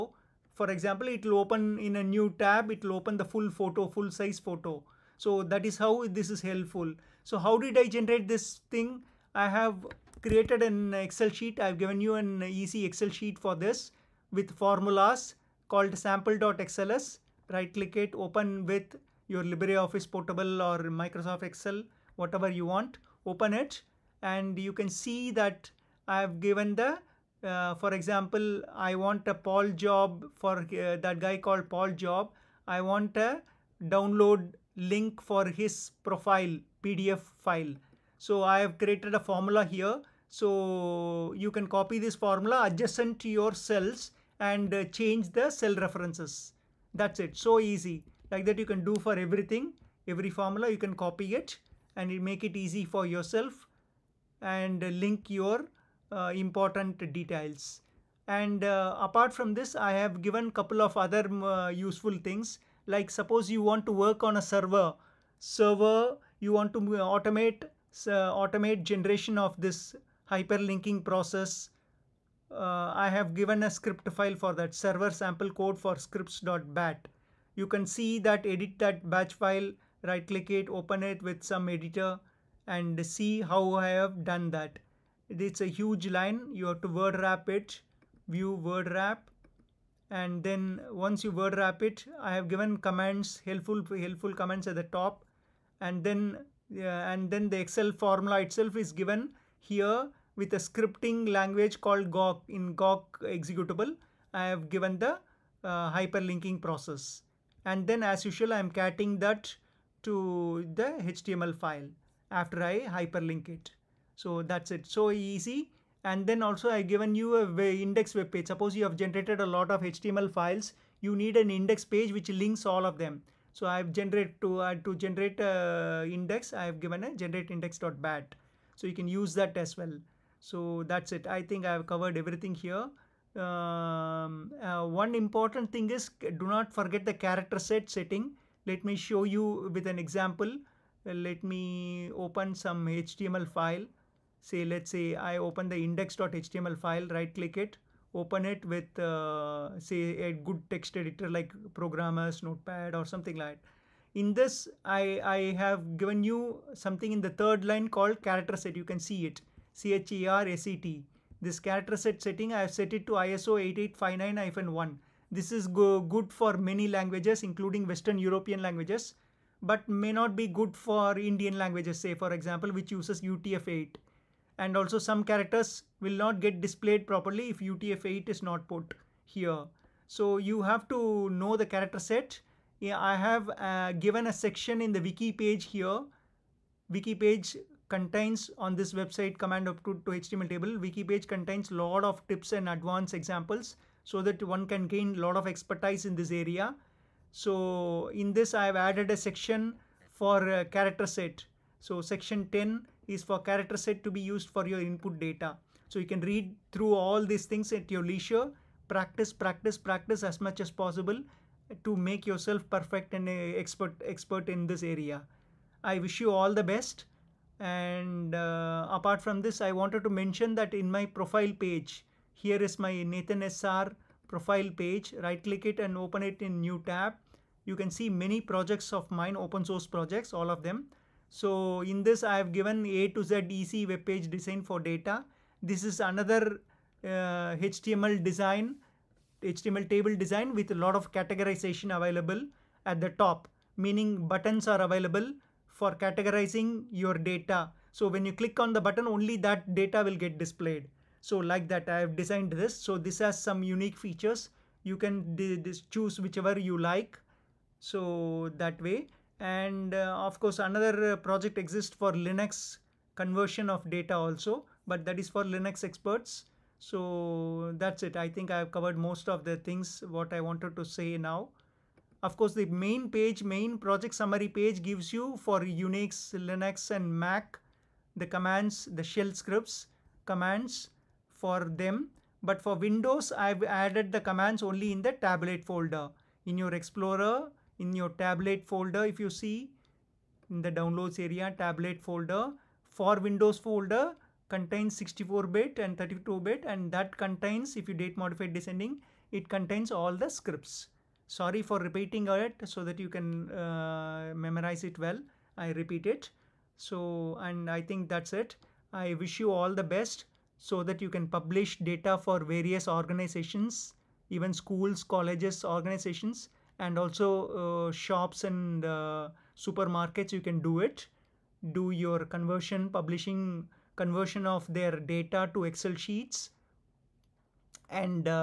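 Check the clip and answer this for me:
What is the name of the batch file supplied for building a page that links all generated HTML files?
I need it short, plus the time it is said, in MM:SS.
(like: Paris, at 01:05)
generate index.bat, at 02:07.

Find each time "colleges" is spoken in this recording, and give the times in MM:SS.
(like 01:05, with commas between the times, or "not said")
05:15.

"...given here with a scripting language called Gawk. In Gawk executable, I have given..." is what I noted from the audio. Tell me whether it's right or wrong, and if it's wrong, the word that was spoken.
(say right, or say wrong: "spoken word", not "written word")
right.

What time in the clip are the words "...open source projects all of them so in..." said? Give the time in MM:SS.
03:49.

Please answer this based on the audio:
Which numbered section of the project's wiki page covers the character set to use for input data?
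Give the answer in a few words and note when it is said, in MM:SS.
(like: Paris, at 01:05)
Section 10, at 03:22.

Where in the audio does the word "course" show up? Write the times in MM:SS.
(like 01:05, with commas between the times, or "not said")
04:20, 04:32.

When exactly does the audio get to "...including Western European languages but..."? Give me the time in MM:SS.
02:47.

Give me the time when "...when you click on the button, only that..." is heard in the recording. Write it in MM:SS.
04:08.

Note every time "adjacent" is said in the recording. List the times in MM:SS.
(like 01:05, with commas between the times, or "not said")
00:42.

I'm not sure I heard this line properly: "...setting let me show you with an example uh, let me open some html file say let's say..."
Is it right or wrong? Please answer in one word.
right.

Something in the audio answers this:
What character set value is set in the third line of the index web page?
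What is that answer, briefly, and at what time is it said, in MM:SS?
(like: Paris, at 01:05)
ISO 8859-1, at 02:43.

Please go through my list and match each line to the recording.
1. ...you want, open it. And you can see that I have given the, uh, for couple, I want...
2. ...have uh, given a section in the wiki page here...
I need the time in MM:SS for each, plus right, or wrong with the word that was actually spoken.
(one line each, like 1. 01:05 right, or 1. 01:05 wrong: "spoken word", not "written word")
1. 00:22 wrong: "example", not "couple"
2. 03:03 right.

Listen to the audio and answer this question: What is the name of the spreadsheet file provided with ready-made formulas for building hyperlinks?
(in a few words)
sample.xls.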